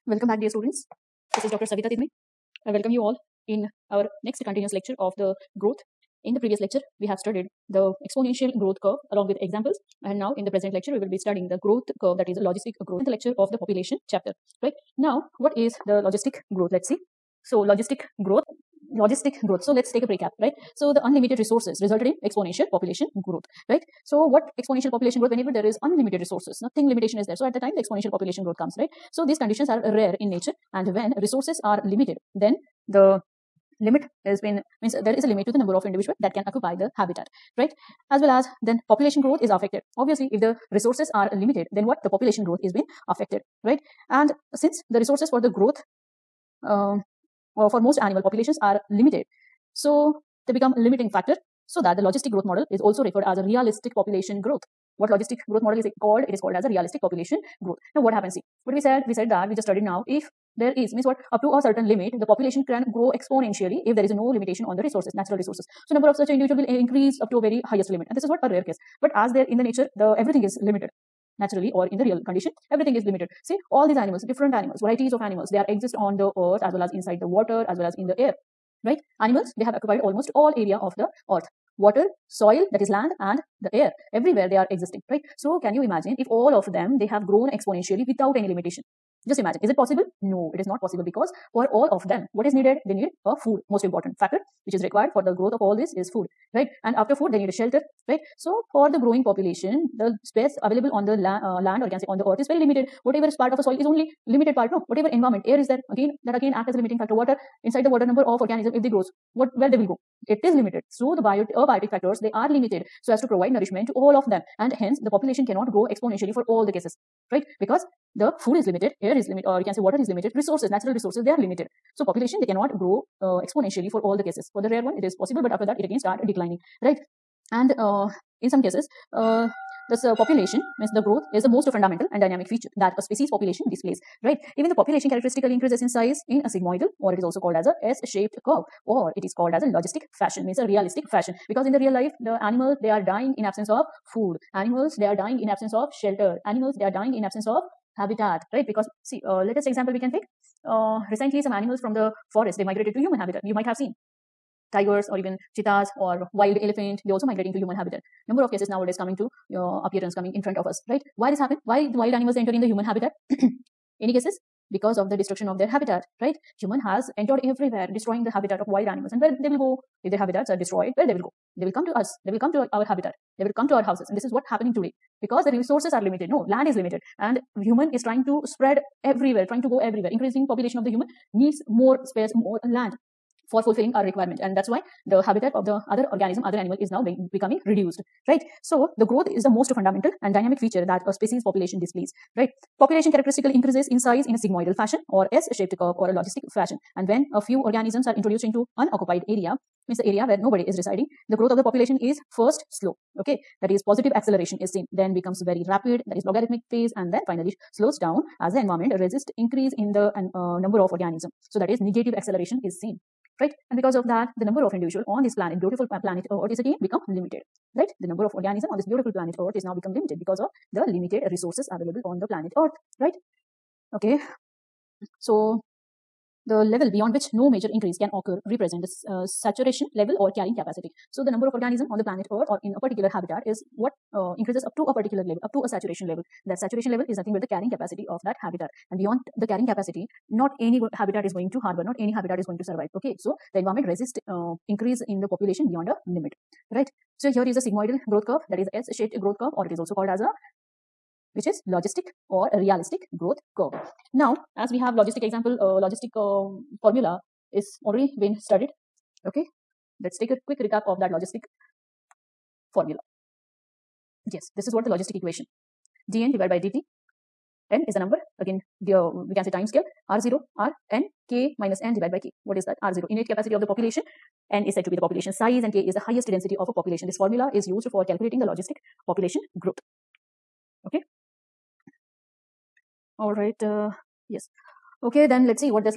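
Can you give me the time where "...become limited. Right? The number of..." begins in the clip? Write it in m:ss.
3:36.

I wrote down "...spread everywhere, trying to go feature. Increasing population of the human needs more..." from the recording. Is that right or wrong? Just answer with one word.
wrong.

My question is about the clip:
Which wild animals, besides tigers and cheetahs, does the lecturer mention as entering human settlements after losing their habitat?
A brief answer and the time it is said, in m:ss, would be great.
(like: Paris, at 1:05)
Wild elephant, at 2:36.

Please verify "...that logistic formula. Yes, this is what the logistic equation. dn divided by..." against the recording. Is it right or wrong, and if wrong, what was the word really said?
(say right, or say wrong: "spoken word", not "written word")
right.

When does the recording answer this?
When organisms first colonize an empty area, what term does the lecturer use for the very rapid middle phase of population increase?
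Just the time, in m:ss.
3:26.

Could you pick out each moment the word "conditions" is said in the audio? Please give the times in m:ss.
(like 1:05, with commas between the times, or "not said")
0:29, 1:12.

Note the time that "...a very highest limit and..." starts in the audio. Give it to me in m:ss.
1:07.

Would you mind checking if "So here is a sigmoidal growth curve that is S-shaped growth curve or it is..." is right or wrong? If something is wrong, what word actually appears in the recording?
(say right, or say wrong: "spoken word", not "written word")
right.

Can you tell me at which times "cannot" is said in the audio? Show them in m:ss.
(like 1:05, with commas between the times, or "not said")
1:55, 2:02.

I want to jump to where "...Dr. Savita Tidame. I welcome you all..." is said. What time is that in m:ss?
0:01.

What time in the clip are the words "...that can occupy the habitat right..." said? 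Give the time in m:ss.
0:36.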